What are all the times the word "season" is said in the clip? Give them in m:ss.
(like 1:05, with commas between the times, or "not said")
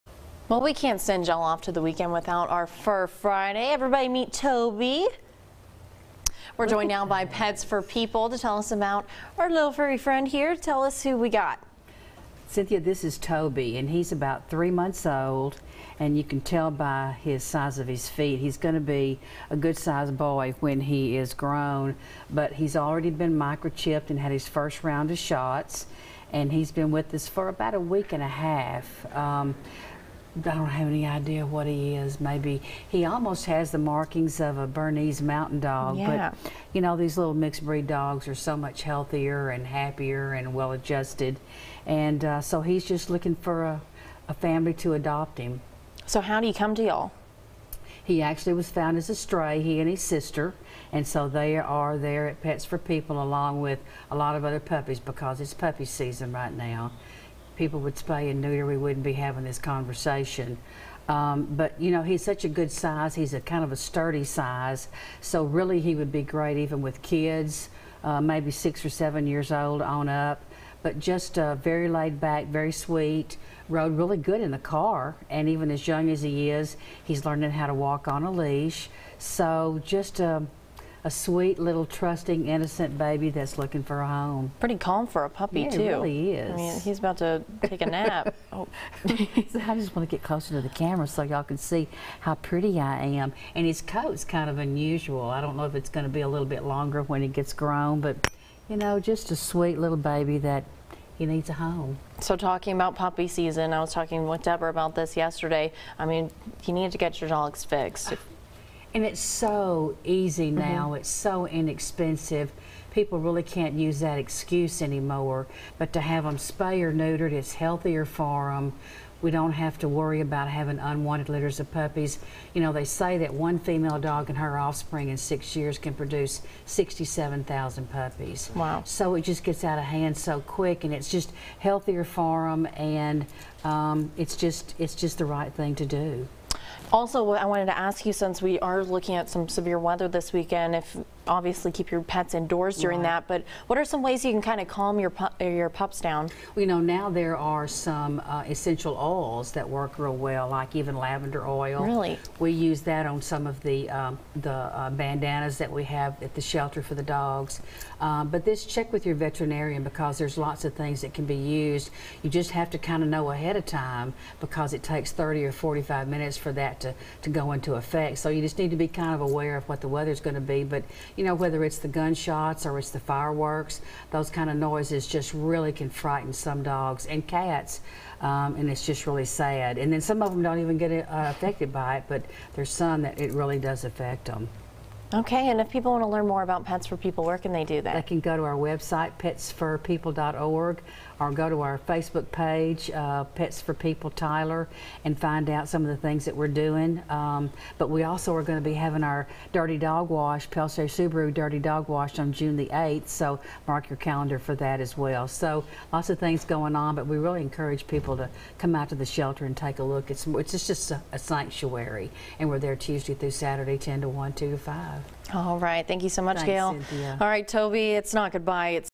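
0:55, 1:43.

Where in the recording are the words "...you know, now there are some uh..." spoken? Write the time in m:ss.
2:26.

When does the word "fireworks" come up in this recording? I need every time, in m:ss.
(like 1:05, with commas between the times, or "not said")
2:52.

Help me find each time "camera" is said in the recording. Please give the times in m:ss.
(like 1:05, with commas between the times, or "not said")
1:30.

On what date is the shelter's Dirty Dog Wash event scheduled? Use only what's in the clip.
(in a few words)
June 8.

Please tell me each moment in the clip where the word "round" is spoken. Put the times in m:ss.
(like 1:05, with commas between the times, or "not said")
0:24.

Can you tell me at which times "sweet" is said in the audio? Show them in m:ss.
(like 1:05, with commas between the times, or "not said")
1:12, 1:21, 1:39.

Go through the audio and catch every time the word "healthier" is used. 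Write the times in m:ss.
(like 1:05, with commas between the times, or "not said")
0:38, 1:57, 2:11.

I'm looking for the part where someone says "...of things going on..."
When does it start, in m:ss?
3:26.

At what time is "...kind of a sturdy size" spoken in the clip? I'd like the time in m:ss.
1:03.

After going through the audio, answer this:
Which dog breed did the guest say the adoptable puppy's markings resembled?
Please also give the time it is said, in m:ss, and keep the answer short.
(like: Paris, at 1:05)
Bernese mountain dog, at 0:34.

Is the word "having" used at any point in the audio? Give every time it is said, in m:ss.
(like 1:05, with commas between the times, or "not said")
0:59, 2:00, 3:18.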